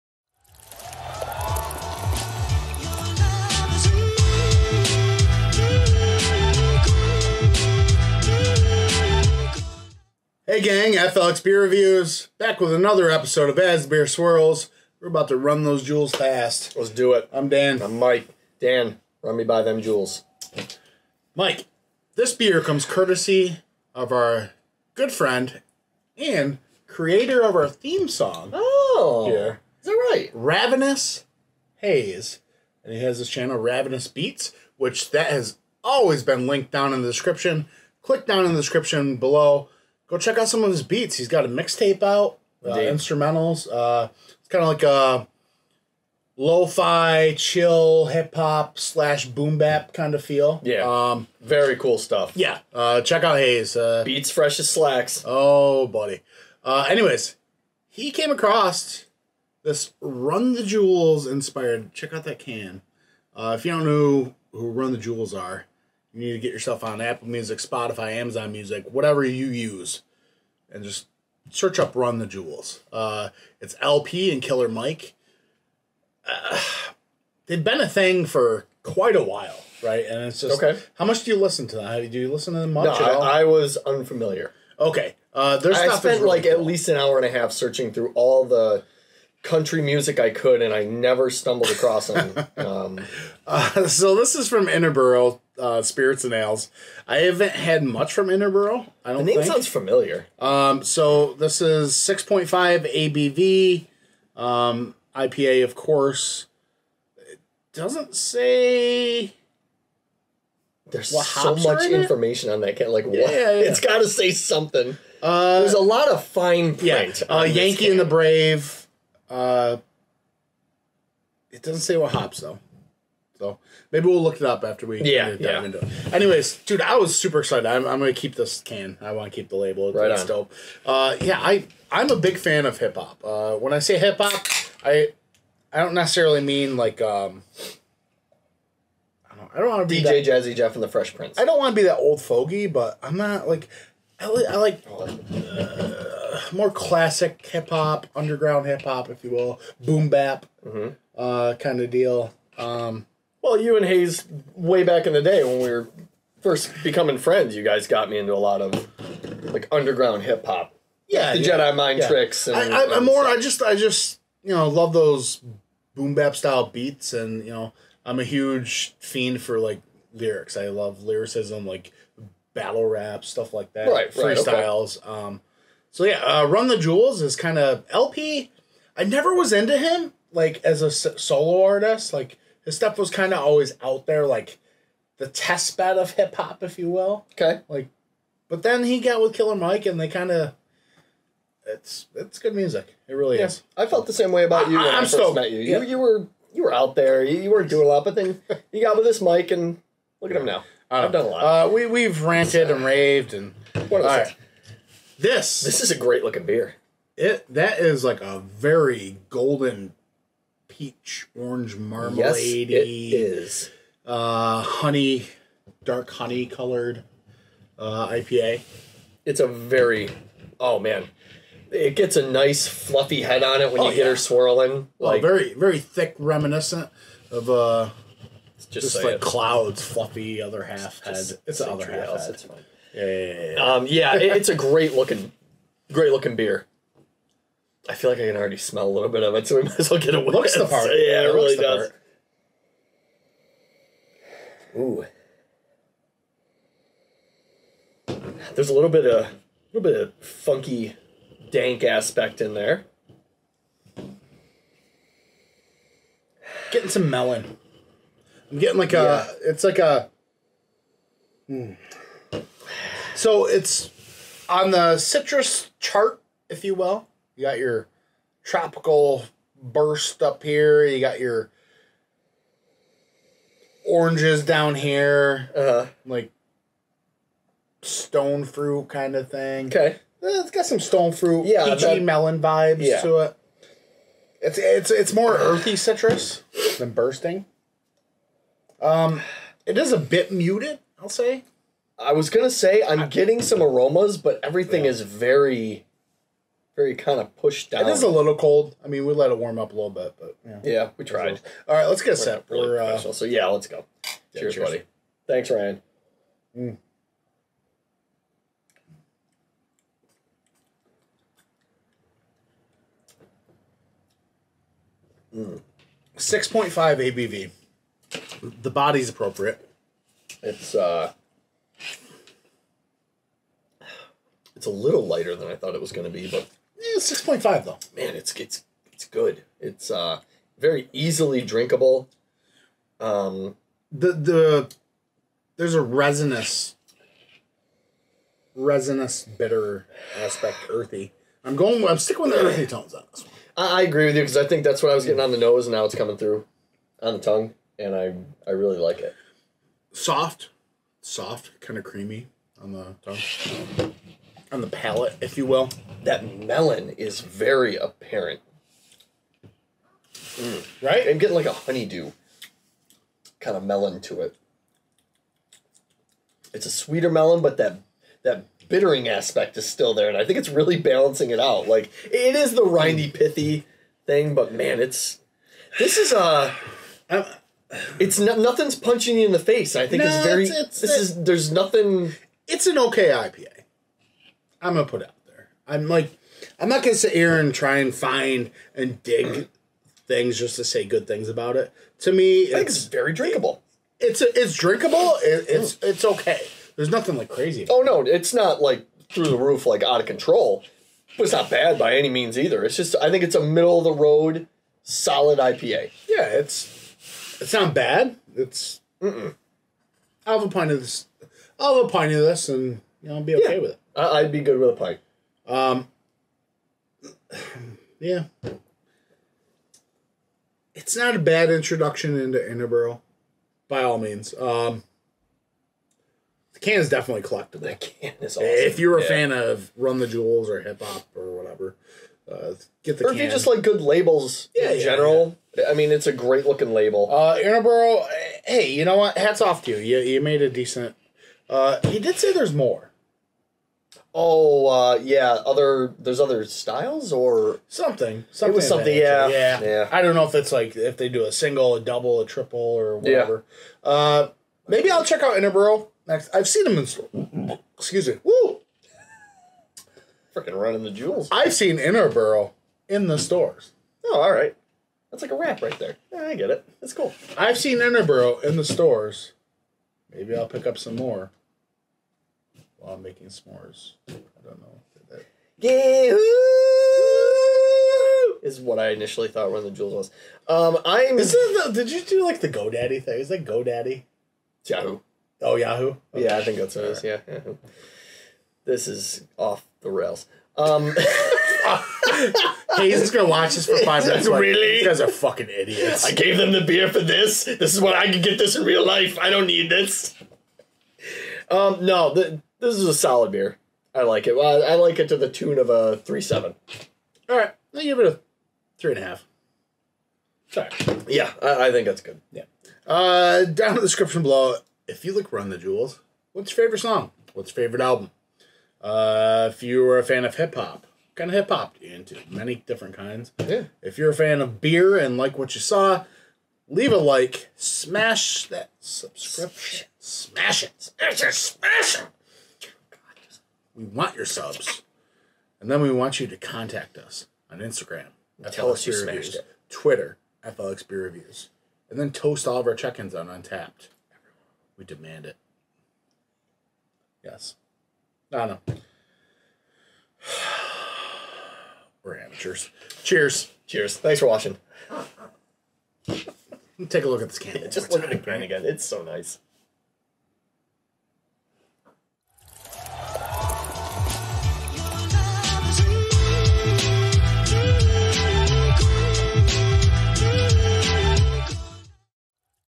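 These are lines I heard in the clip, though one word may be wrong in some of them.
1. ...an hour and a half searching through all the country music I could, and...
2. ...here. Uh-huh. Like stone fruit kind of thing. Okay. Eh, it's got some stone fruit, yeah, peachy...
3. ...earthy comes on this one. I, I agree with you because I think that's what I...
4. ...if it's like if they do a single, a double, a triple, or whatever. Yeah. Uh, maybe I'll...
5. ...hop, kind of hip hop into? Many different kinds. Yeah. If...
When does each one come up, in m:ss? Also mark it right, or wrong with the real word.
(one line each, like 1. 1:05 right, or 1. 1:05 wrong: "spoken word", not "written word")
1. 1:26 right
2. 4:34 right
3. 5:42 wrong: "tones", not "comes"
4. 7:30 right
5. 8:40 right.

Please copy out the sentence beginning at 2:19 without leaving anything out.
I don't, I don't want to be DJ that, Jazzy Jeff and the Fresh Prince.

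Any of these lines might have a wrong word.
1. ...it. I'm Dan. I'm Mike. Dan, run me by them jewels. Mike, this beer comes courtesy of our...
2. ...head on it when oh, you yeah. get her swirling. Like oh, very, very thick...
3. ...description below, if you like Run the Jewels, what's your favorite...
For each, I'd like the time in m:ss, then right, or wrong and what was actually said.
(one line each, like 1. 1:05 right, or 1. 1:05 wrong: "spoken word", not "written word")
1. 0:17 right
2. 3:43 right
3. 8:33 right.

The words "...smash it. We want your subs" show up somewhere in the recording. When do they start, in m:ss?
8:51.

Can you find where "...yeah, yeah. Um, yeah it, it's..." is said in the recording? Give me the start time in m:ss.
3:53.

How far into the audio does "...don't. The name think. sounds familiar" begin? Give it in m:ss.
1:39.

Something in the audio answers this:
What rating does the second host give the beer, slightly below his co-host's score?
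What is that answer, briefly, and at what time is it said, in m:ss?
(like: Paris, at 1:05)
3.5, at 8:28.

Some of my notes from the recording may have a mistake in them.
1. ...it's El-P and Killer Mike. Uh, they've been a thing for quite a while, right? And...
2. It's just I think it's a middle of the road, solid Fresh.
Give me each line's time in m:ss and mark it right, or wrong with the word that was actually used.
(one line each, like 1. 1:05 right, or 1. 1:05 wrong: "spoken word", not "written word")
1. 1:13 right
2. 6:42 wrong: "IPA", not "Fresh".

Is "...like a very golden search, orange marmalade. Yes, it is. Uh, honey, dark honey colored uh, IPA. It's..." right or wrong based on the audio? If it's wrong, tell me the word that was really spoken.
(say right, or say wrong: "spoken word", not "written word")
wrong: "peach", not "search".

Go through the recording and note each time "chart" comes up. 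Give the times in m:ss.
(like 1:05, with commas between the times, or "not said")
4:25.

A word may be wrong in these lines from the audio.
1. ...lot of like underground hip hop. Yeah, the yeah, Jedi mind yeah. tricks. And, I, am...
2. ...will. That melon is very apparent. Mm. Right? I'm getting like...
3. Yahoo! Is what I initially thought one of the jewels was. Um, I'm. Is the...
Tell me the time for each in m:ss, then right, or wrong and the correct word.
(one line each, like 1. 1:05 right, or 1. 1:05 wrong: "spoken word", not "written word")
1. 2:38 right
2. 5:55 right
3. 7:55 right.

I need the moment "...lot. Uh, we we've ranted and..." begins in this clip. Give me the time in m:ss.
3:21.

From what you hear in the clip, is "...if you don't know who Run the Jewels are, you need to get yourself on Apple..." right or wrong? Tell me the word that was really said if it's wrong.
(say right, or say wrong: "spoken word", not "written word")
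right.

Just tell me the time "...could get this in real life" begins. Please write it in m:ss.
8:18.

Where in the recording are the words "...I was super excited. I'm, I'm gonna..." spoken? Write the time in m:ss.
2:06.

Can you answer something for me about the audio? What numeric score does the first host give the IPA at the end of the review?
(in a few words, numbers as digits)
3.7.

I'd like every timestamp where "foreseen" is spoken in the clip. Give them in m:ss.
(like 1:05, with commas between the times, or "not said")
not said.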